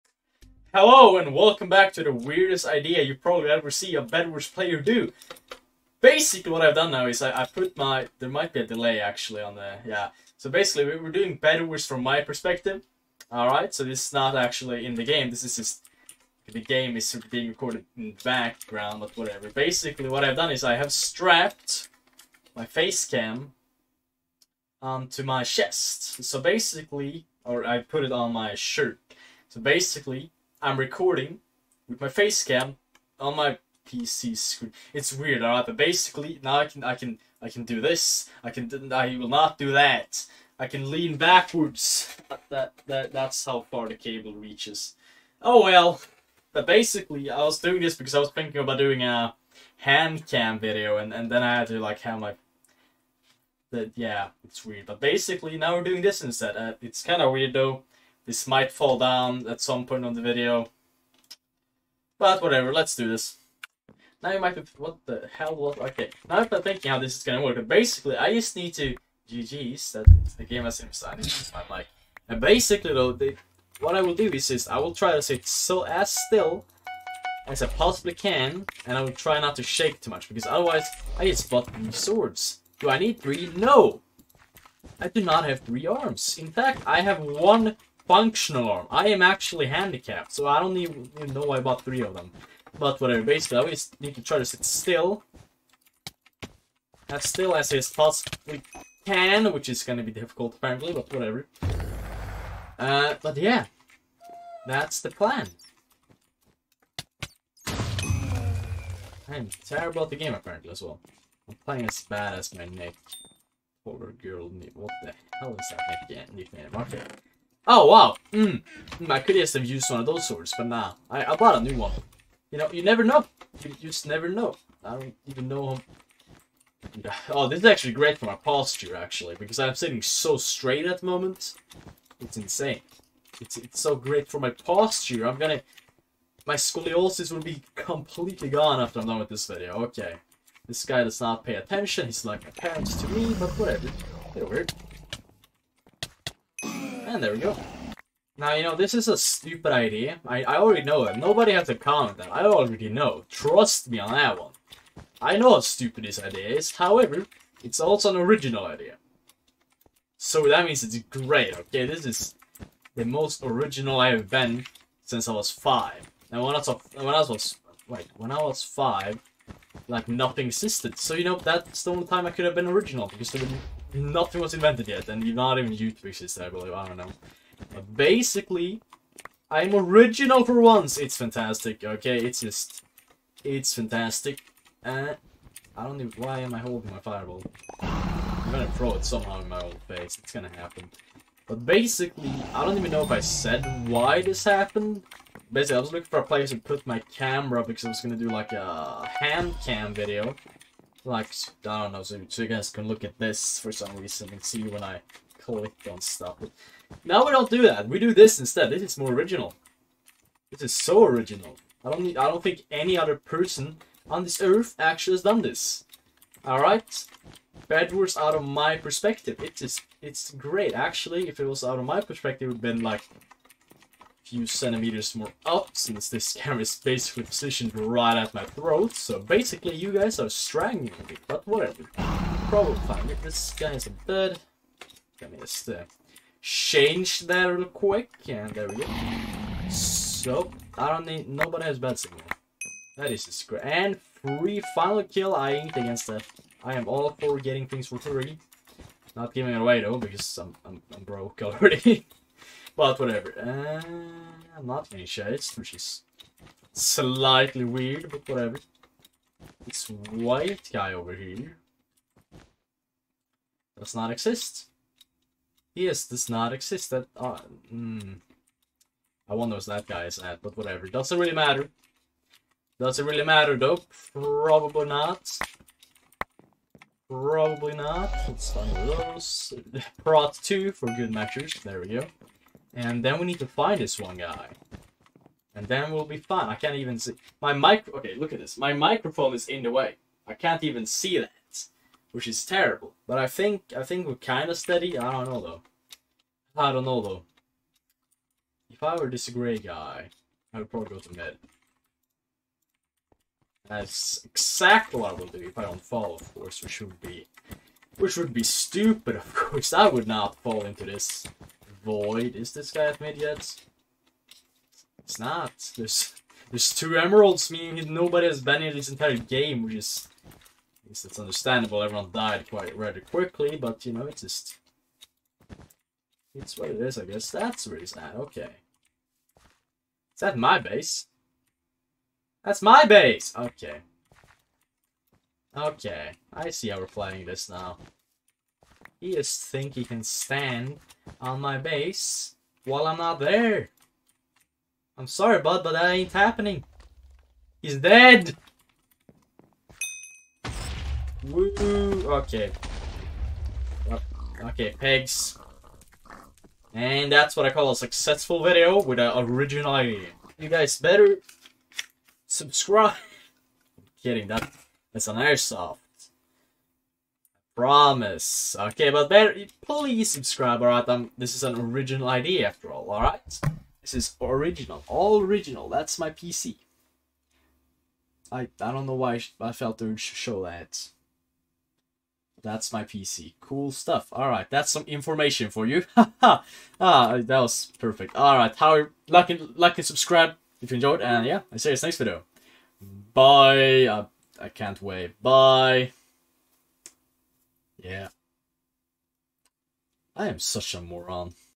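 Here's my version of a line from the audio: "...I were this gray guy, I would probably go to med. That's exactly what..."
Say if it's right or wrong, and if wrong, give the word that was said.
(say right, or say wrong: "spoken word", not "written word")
right.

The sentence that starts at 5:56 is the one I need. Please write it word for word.
And that's what I call a successful video with an original idea.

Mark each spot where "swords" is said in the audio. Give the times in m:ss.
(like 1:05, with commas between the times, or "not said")
1:21, 2:00.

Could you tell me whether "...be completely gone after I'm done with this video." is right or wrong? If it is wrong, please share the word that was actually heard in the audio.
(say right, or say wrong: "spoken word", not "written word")
right.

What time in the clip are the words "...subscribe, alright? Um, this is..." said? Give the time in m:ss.
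6:10.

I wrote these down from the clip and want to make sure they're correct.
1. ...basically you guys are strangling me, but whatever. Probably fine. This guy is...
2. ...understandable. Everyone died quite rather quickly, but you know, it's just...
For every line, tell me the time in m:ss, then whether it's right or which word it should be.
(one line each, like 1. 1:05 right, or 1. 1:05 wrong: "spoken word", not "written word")
1. 3:49 right
2. 5:21 right.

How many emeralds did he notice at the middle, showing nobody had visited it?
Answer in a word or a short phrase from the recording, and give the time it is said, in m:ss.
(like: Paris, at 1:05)
2, at 5:16.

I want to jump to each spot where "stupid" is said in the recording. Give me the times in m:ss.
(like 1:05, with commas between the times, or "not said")
2:29, 2:35, 5:08.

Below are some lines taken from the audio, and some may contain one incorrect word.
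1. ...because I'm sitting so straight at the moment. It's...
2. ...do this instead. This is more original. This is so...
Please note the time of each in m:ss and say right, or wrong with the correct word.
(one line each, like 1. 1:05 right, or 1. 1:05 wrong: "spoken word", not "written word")
1. 2:09 right
2. 3:27 right.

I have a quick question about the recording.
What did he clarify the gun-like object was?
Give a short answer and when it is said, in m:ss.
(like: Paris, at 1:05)
An airsoft, at 6:05.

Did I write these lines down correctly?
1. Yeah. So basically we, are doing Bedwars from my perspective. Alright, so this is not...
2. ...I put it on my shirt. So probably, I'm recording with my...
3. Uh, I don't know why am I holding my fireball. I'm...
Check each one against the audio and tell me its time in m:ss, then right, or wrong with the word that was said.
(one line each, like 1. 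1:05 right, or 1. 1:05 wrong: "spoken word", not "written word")
1. 0:09 right
2. 0:27 wrong: "basically", not "probably"
3. 3:04 right.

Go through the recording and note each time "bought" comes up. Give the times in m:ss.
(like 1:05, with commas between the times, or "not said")
1:21, 1:31, 2:01.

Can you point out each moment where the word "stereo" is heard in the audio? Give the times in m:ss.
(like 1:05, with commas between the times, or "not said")
not said.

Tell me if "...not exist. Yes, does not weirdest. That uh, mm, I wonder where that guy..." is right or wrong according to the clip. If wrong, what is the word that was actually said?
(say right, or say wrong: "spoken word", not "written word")
wrong: "exist", not "weirdest".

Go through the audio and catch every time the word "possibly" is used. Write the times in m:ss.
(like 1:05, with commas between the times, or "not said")
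1:17, 1:37.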